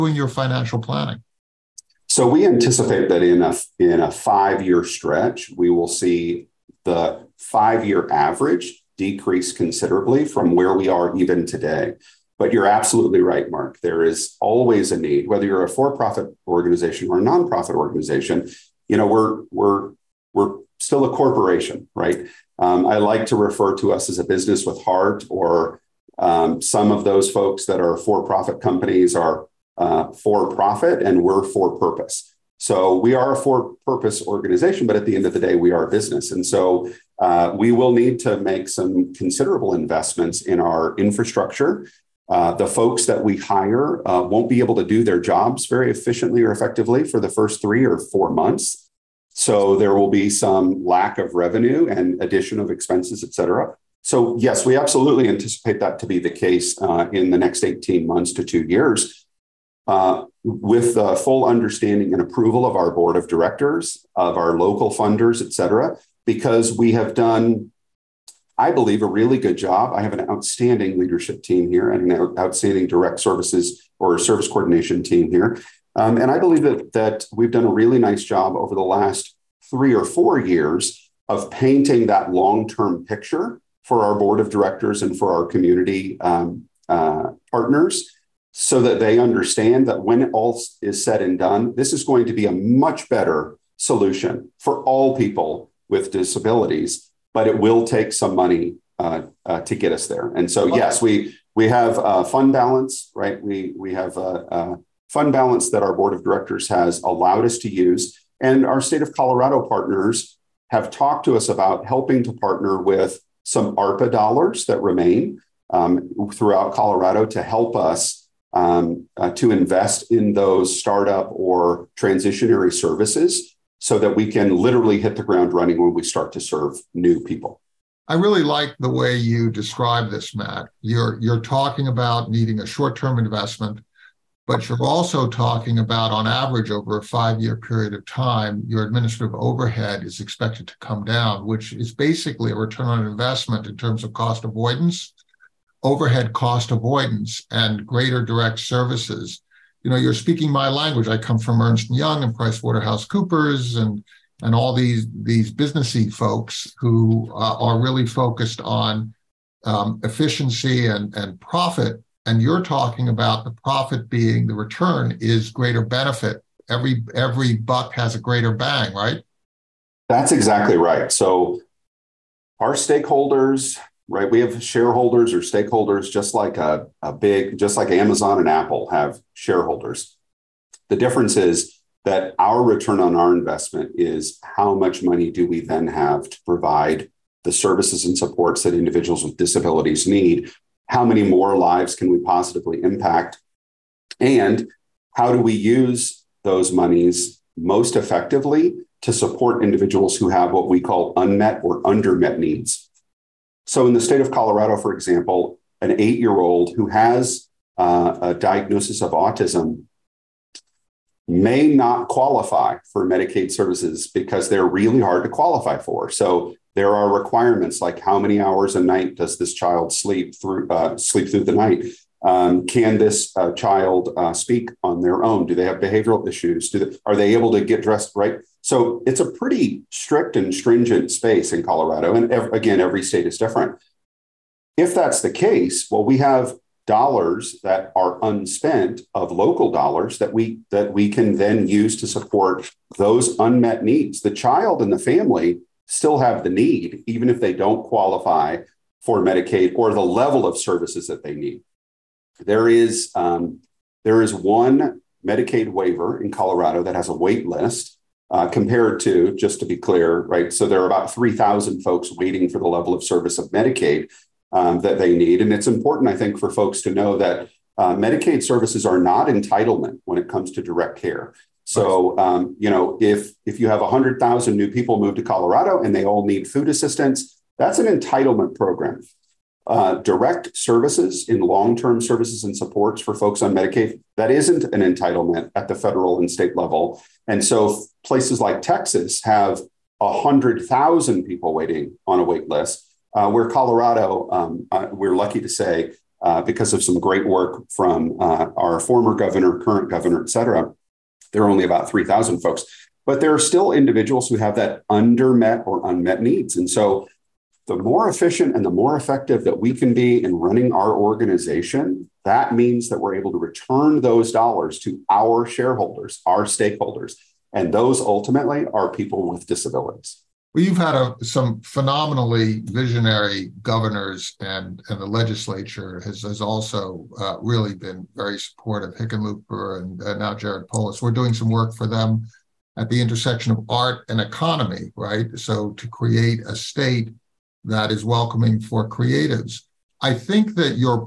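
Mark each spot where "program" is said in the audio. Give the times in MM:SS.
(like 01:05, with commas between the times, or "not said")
04:38.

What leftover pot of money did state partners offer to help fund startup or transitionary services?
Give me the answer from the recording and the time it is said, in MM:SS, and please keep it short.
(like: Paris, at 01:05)
ARPA dollars, at 01:53.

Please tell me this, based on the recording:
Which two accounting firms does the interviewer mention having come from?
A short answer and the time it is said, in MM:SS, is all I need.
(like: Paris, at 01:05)
Ernst Young and PricewaterhouseCoopers, at 02:31.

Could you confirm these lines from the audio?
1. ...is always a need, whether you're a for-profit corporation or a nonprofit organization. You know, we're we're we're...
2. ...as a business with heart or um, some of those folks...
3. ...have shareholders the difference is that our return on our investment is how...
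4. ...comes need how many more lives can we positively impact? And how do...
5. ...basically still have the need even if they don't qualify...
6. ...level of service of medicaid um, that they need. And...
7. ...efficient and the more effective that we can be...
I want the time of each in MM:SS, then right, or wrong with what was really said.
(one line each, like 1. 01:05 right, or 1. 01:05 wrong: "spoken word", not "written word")
1. 00:14 wrong: "organization", not "corporation"
2. 00:24 right
3. 02:58 right
4. 03:09 wrong: "disabilities", not "comes"
5. 04:04 wrong: "family", not "basically"
6. 04:22 right
7. 05:08 right.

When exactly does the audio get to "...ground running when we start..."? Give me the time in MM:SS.
02:05.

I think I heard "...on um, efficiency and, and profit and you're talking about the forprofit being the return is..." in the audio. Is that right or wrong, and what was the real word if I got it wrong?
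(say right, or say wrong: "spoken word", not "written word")
wrong: "profit", not "forprofit".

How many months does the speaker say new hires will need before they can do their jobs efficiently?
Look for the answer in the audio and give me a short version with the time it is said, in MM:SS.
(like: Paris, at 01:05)
3 or 4 months, at 00:47.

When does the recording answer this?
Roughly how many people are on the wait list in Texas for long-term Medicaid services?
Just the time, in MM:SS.
04:49.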